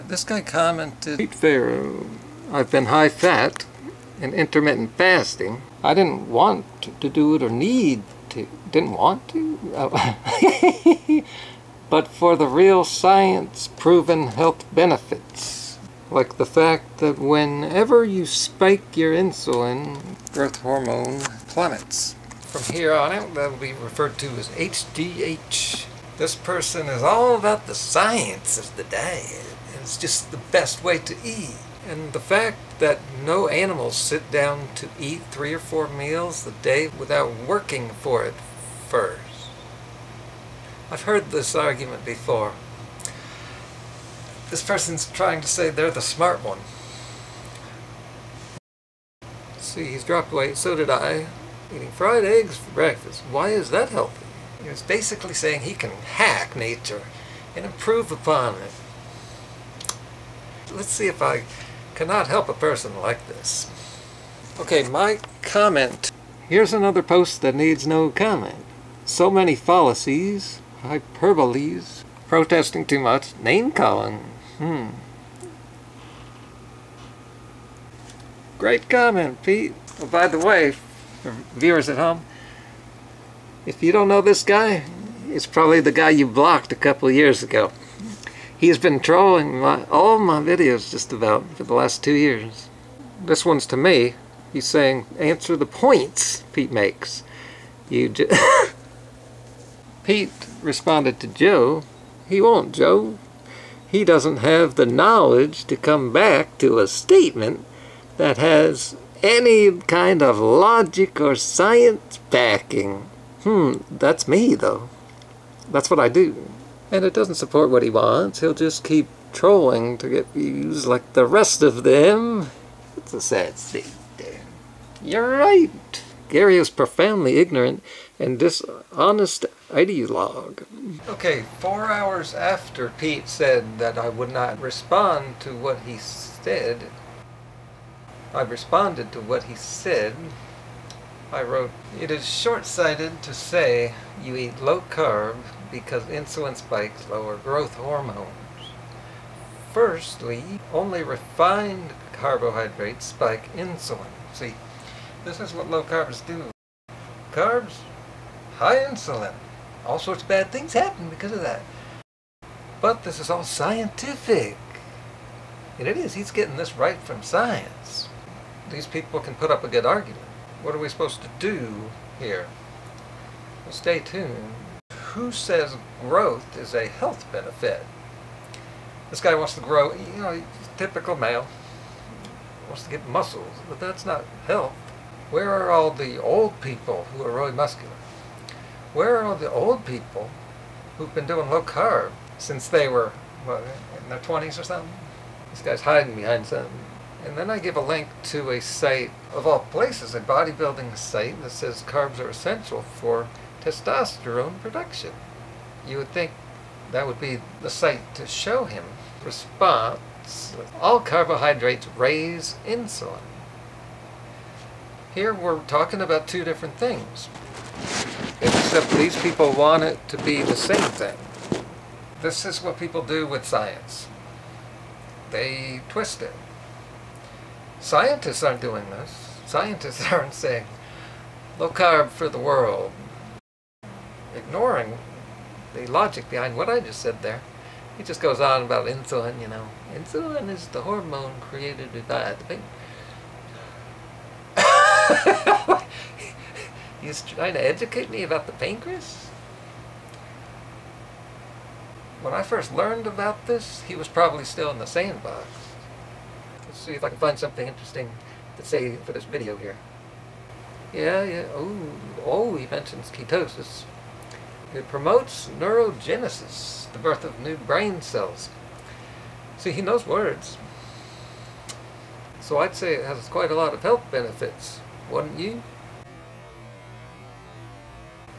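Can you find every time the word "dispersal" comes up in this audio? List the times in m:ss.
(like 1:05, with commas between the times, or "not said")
not said.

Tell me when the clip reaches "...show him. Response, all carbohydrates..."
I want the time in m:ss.
3:28.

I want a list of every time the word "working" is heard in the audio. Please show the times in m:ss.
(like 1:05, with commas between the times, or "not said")
0:37.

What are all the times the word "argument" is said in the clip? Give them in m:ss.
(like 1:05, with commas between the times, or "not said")
0:41, 2:49.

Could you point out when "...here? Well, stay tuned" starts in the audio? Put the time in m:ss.
2:52.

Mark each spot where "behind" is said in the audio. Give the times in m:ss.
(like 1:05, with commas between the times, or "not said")
3:16, 3:56.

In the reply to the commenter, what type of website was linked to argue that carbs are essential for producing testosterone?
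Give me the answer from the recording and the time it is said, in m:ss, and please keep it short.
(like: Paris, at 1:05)
bodybuilding site, at 3:20.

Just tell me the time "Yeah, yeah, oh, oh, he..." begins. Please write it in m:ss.
4:20.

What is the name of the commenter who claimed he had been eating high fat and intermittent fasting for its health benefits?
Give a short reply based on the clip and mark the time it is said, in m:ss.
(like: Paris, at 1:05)
Pete Pharaoh, at 0:01.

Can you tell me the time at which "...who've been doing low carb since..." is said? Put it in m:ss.
3:10.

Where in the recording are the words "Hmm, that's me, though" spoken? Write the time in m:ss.
1:53.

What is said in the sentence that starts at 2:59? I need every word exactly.
This guy wants to grow, you know, typical male, wants to get muscles, but that's not health.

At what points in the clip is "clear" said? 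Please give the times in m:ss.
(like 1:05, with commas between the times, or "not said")
not said.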